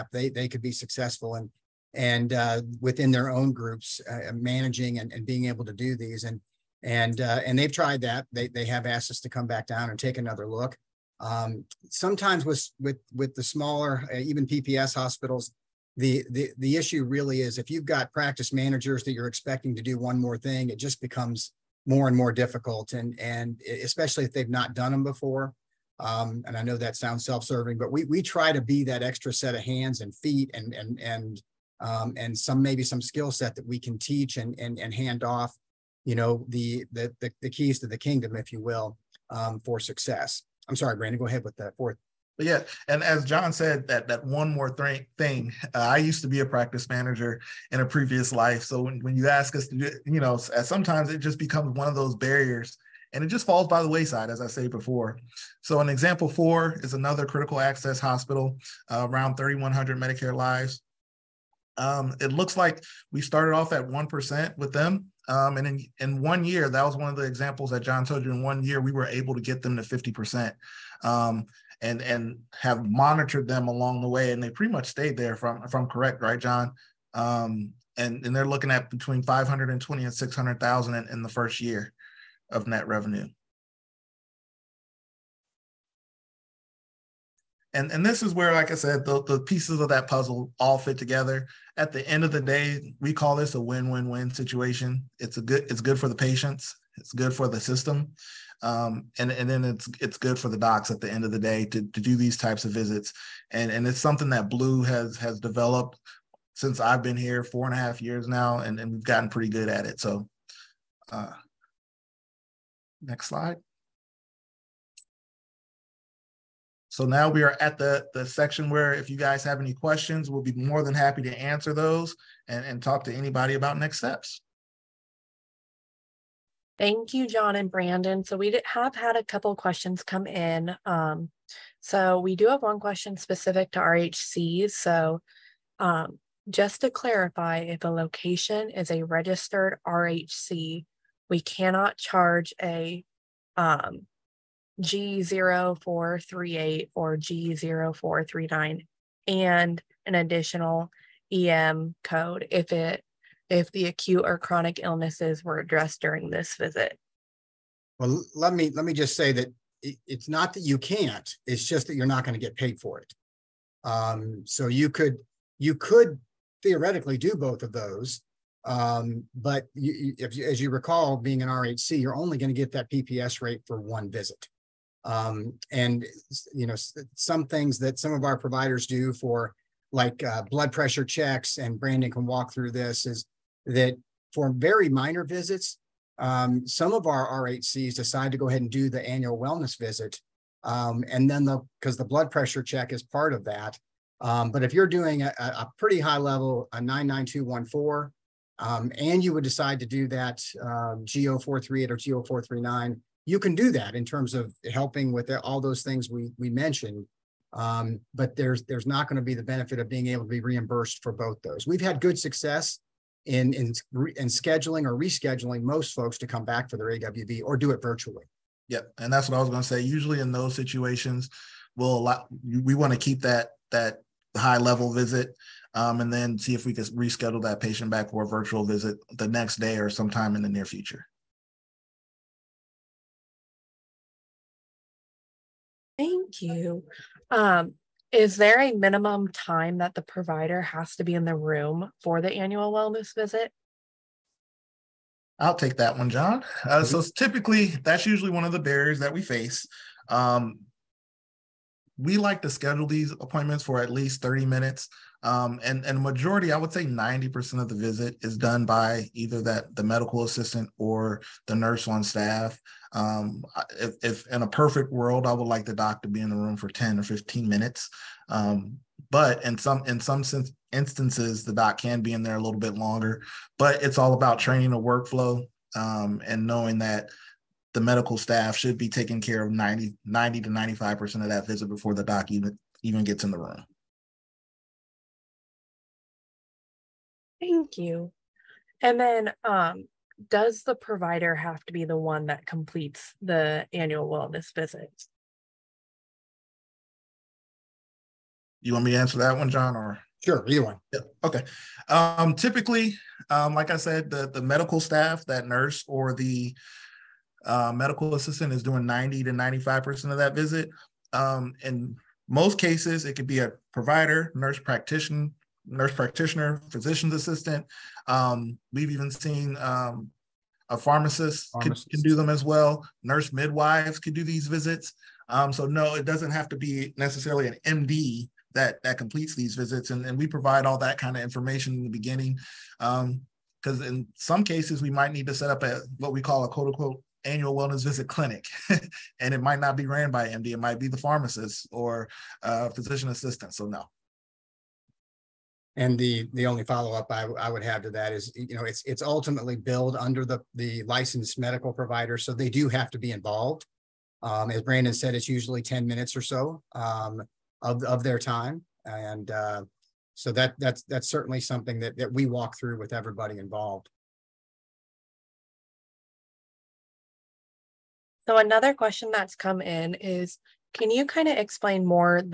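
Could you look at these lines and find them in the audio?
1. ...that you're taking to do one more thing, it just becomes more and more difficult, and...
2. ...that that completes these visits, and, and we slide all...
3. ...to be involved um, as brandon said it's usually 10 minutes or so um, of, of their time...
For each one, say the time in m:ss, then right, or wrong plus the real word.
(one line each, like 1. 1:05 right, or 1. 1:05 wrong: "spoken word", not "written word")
1. 0:19 wrong: "expecting", not "taking"
2. 5:28 wrong: "provide", not "slide"
3. 5:52 right.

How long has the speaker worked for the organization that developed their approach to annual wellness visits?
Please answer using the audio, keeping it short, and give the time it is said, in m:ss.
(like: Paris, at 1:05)
4 and a half years, at 1:47.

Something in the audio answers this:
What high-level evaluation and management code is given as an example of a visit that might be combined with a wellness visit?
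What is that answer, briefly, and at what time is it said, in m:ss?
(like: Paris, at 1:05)
99214, at 3:16.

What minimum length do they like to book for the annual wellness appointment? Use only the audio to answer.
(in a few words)
30 minutes.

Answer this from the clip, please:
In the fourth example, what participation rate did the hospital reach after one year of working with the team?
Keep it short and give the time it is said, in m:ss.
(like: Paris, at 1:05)
50%, at 1:09.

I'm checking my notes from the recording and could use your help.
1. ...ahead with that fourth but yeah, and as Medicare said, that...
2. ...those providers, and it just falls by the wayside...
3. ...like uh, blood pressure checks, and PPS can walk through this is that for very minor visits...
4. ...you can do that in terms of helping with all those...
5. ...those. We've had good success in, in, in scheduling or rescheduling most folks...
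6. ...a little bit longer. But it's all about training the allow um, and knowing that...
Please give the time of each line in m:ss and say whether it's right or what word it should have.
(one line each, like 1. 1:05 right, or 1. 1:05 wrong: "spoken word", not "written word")
1. 0:41 wrong: "John", not "Medicare"
2. 0:51 wrong: "barriers", not "providers"
3. 2:59 wrong: "Brandon", not "PPS"
4. 3:23 right
5. 3:31 right
6. 4:32 wrong: "workflow", not "allow".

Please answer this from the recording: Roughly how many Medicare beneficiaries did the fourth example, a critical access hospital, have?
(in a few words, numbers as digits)
3,100.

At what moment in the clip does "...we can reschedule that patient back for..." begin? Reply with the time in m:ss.
3:46.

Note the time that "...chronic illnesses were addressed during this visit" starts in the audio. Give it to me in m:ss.
2:34.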